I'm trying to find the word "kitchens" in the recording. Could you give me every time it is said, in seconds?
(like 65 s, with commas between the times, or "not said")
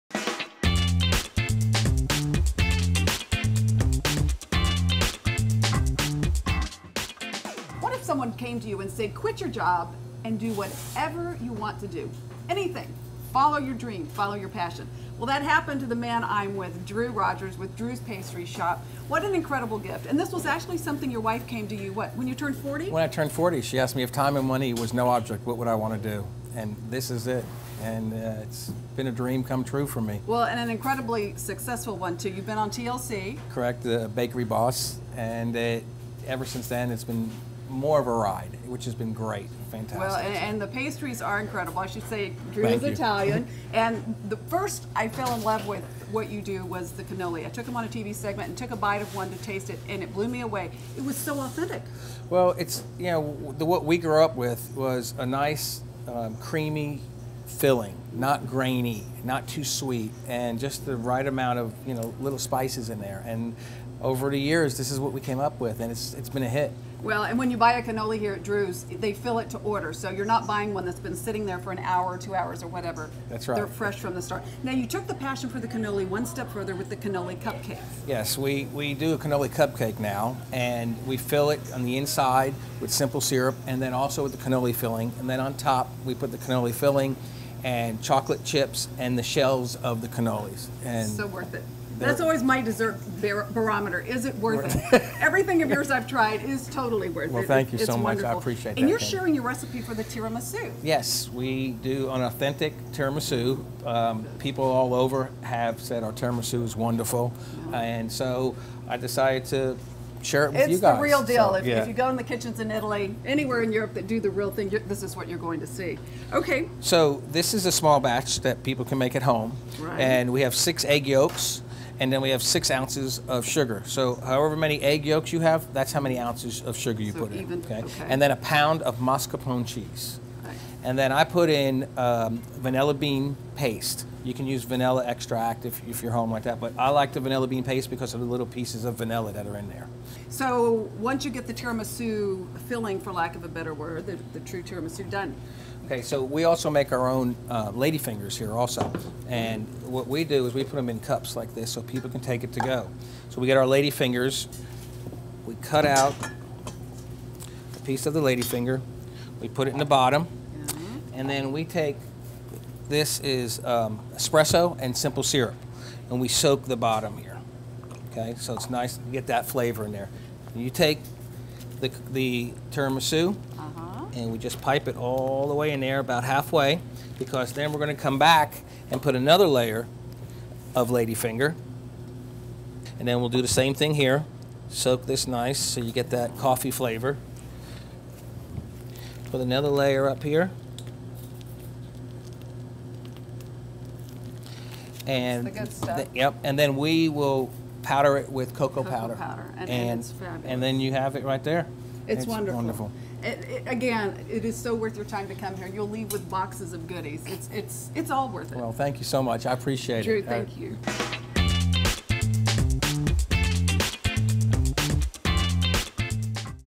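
112 s.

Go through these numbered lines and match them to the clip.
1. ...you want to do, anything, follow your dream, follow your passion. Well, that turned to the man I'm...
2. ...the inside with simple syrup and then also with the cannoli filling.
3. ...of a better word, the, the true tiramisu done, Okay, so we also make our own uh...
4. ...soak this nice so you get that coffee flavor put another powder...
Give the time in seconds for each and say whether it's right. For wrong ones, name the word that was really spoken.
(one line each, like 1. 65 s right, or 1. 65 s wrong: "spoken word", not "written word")
1. 11 s wrong: "happened", not "turned"
2. 81 s right
3. 143 s right
4. 184 s wrong: "layer", not "powder".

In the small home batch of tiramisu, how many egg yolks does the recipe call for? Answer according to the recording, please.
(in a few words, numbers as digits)
6.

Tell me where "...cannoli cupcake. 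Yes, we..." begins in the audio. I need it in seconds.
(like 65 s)
76 s.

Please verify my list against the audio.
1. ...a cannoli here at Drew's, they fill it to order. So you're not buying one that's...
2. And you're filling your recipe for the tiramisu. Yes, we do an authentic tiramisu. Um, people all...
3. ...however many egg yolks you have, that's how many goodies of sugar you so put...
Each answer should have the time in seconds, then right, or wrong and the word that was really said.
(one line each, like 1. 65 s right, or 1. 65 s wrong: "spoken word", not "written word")
1. 67 s right
2. 98 s wrong: "sharing", not "filling"
3. 124 s wrong: "ounces", not "goodies".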